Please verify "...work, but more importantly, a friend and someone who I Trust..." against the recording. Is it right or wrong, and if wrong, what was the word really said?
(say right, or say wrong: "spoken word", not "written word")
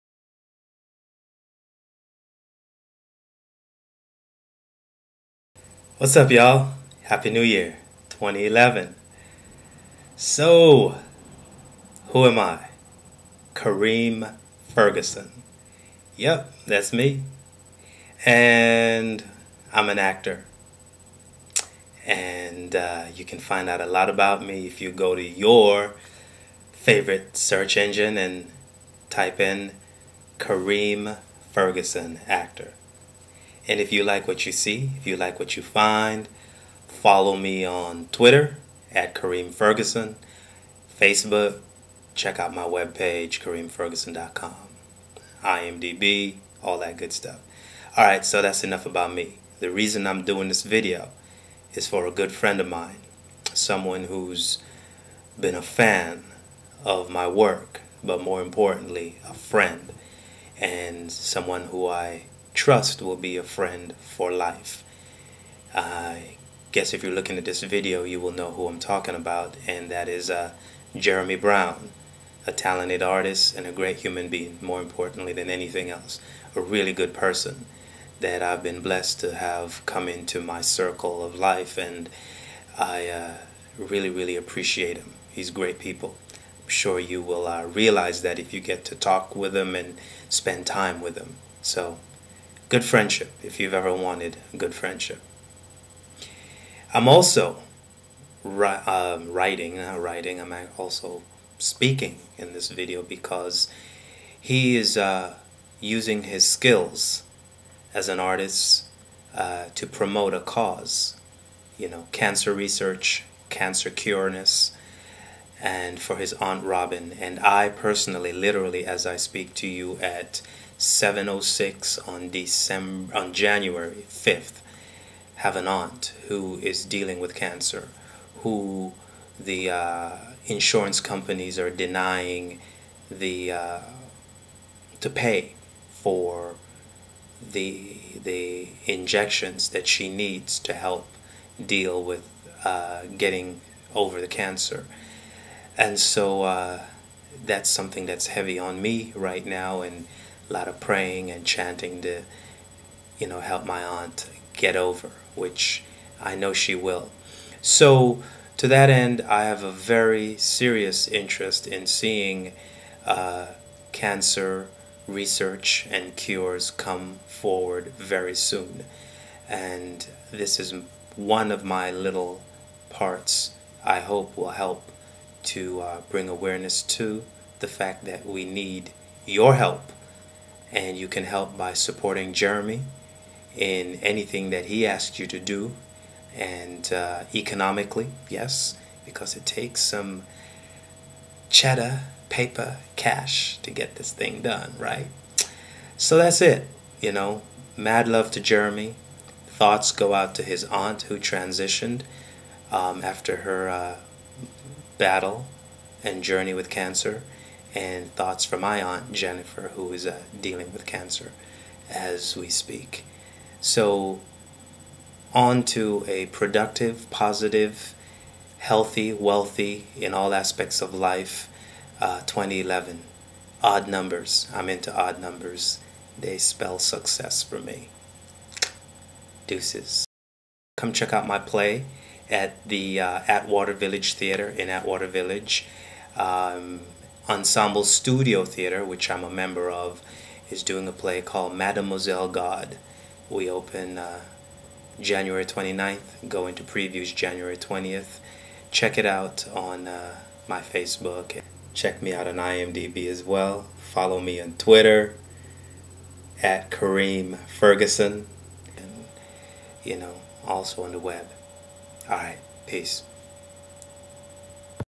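right.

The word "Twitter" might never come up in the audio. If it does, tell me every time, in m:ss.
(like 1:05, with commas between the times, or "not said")
0:38, 4:14.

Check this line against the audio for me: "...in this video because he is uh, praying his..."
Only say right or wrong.
wrong.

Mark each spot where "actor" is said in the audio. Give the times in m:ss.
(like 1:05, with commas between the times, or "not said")
0:19, 0:32.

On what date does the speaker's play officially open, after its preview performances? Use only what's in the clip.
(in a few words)
January 29th.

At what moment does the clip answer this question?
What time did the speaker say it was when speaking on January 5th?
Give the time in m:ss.
2:00.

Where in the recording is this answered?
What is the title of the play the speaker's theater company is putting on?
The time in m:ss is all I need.
4:01.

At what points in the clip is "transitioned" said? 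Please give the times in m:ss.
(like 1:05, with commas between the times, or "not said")
3:21.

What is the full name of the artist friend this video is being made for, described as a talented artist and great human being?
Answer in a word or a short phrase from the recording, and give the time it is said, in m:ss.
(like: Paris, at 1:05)
Jeremy Brown, at 1:10.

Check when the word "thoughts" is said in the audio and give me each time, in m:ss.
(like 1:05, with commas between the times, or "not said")
3:19, 3:28.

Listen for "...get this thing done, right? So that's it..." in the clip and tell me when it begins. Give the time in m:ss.
3:13.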